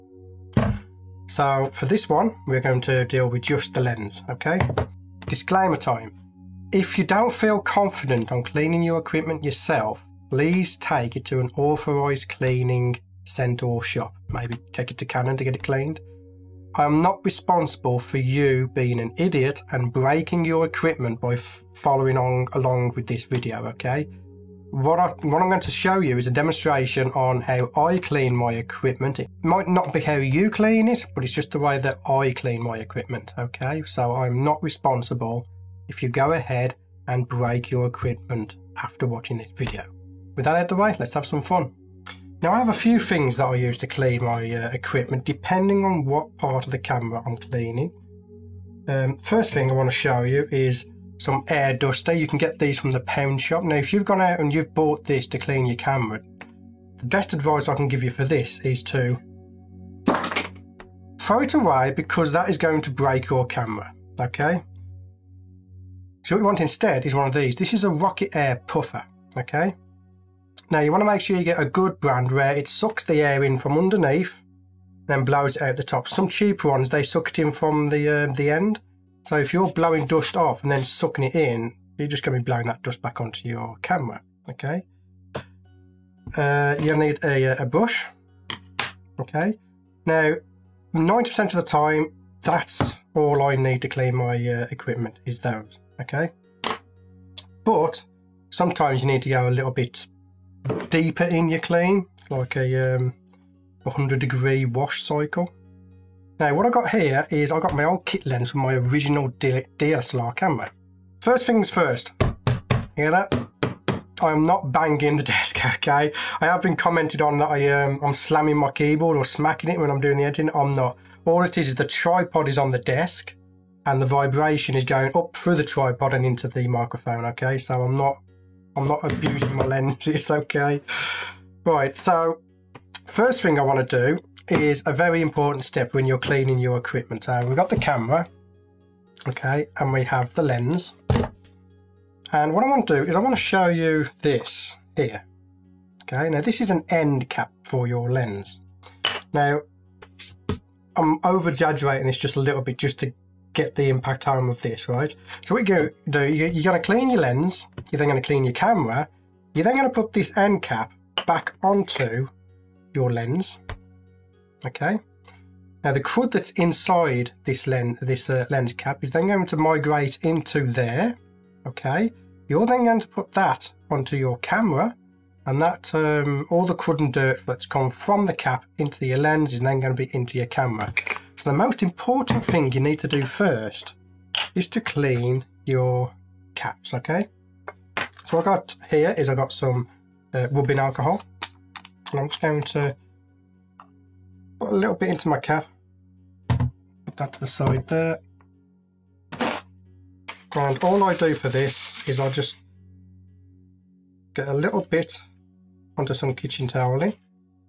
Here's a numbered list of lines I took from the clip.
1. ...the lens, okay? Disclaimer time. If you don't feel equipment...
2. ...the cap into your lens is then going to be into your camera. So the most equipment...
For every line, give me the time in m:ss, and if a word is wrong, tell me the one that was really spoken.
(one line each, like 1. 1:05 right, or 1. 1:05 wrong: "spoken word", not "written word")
1. 0:03 wrong: "confident", not "equipment"
2. 2:58 wrong: "important", not "equipment".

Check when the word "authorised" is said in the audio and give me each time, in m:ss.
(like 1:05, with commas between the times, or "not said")
0:11.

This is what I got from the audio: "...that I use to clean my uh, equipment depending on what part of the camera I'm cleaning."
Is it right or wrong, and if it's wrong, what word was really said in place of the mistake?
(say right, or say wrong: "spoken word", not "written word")
right.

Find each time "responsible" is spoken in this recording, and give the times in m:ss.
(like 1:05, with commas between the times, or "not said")
0:17, 0:34.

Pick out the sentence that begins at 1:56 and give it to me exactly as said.
I have been commented on that I, um, I'm slamming my keyboard or smacking it when I'm doing the editing.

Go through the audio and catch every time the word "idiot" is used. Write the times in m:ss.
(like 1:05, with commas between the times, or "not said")
0:19.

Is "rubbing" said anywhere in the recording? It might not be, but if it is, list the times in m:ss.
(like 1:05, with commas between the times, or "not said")
3:10.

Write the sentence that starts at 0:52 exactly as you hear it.
You can get these from the pound shop.